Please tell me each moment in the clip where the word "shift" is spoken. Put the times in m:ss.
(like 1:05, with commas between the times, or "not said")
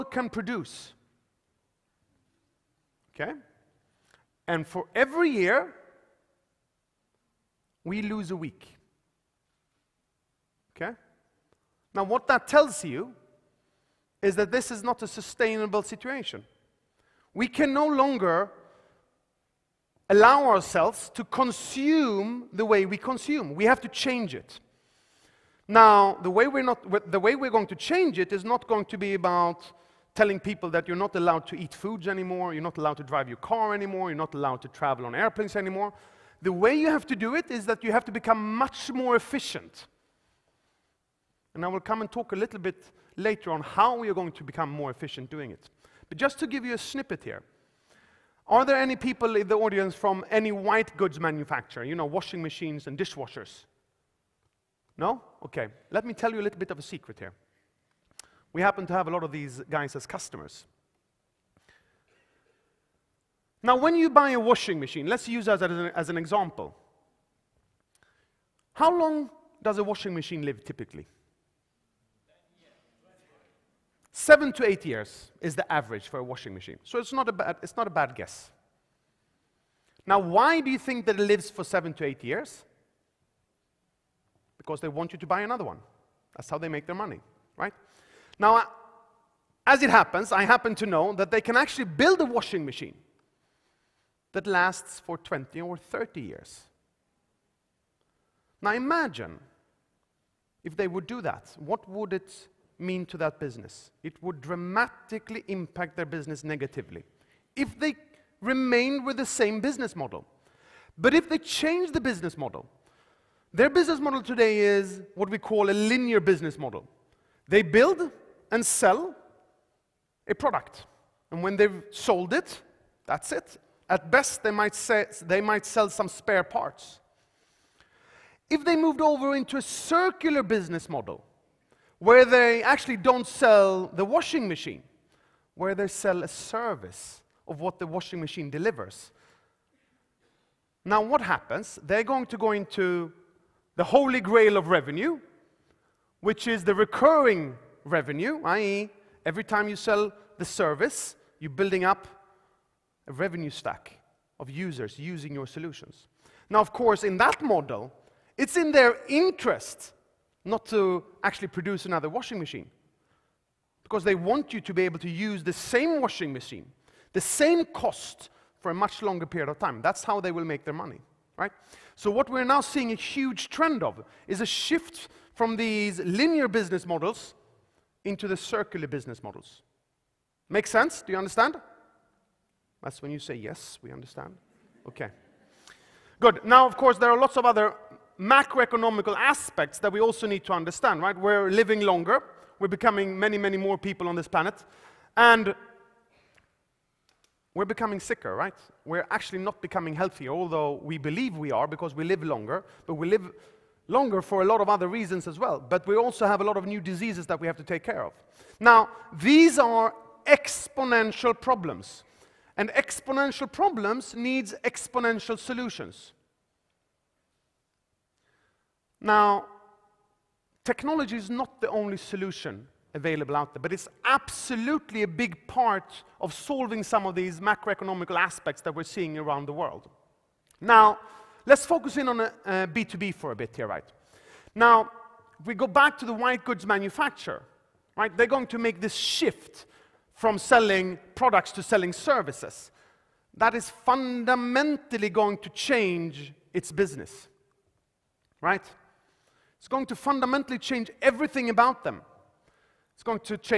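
2:54, 3:58.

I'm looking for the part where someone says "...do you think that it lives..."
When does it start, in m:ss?
1:20.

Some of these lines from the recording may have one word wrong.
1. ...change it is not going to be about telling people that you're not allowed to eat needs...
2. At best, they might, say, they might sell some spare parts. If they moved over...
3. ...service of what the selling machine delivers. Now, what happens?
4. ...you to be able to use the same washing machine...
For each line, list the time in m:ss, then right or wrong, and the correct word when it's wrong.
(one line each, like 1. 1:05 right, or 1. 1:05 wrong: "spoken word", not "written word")
1. 0:27 wrong: "foods", not "needs"
2. 2:03 right
3. 2:16 wrong: "washing", not "selling"
4. 2:44 right.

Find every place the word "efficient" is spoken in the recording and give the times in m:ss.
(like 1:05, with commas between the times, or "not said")
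0:39, 0:44.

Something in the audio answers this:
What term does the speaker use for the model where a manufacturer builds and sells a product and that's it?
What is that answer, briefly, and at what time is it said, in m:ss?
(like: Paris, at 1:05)
linear business model, at 1:55.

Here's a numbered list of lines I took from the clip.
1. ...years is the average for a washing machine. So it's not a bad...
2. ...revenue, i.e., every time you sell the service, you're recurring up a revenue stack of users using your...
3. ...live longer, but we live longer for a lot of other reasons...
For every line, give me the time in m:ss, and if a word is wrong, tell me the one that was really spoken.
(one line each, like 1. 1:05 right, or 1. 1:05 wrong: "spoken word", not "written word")
1. 1:14 right
2. 2:27 wrong: "building", not "recurring"
3. 3:22 right.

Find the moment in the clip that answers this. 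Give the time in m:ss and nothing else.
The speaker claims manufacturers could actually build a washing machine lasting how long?
1:35.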